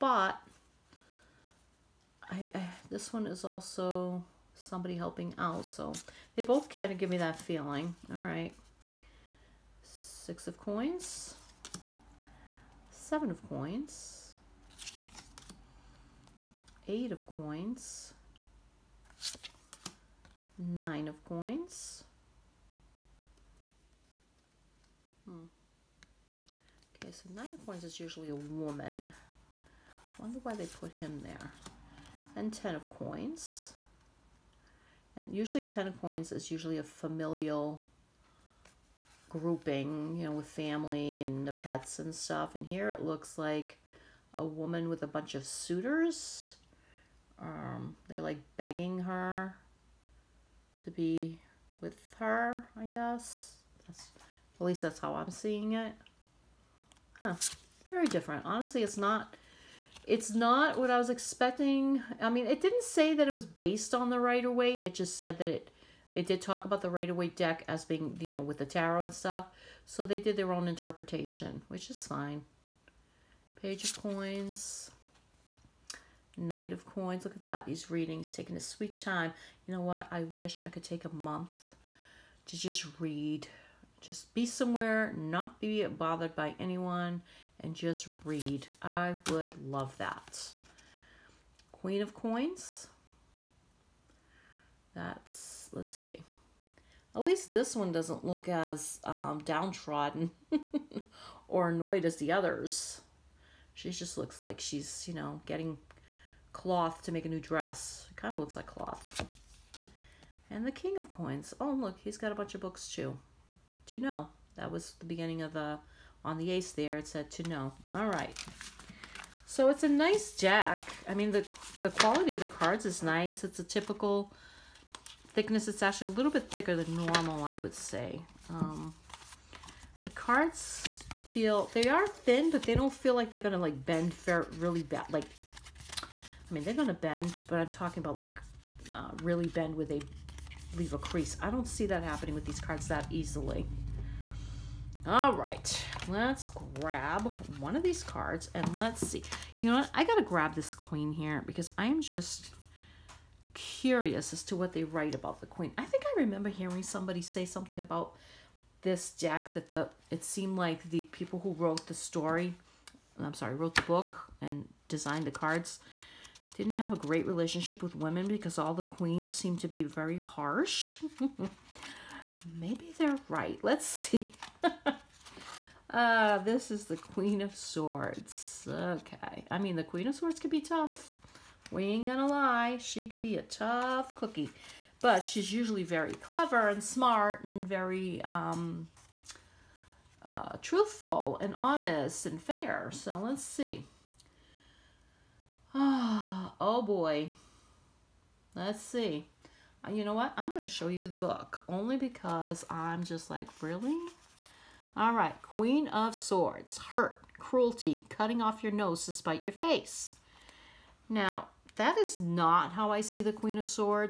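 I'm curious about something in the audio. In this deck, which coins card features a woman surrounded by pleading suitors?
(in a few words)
Ten of Coins.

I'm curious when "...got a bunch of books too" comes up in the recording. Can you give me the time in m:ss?
1:52.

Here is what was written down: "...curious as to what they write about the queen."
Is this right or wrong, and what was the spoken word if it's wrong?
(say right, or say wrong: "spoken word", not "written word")
right.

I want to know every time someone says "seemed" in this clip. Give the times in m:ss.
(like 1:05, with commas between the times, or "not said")
2:40, 2:49.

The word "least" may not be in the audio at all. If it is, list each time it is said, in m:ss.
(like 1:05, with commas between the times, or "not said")
0:54, 1:37.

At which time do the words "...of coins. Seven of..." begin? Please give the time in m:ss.
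0:10.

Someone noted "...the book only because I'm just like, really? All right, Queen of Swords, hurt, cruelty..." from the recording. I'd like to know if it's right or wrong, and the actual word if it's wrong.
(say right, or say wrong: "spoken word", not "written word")
right.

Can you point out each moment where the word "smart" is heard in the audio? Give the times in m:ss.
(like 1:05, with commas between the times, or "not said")
3:06.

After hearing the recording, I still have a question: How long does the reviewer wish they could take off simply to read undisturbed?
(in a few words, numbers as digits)
A month.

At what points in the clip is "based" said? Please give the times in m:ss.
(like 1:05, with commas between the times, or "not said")
1:03.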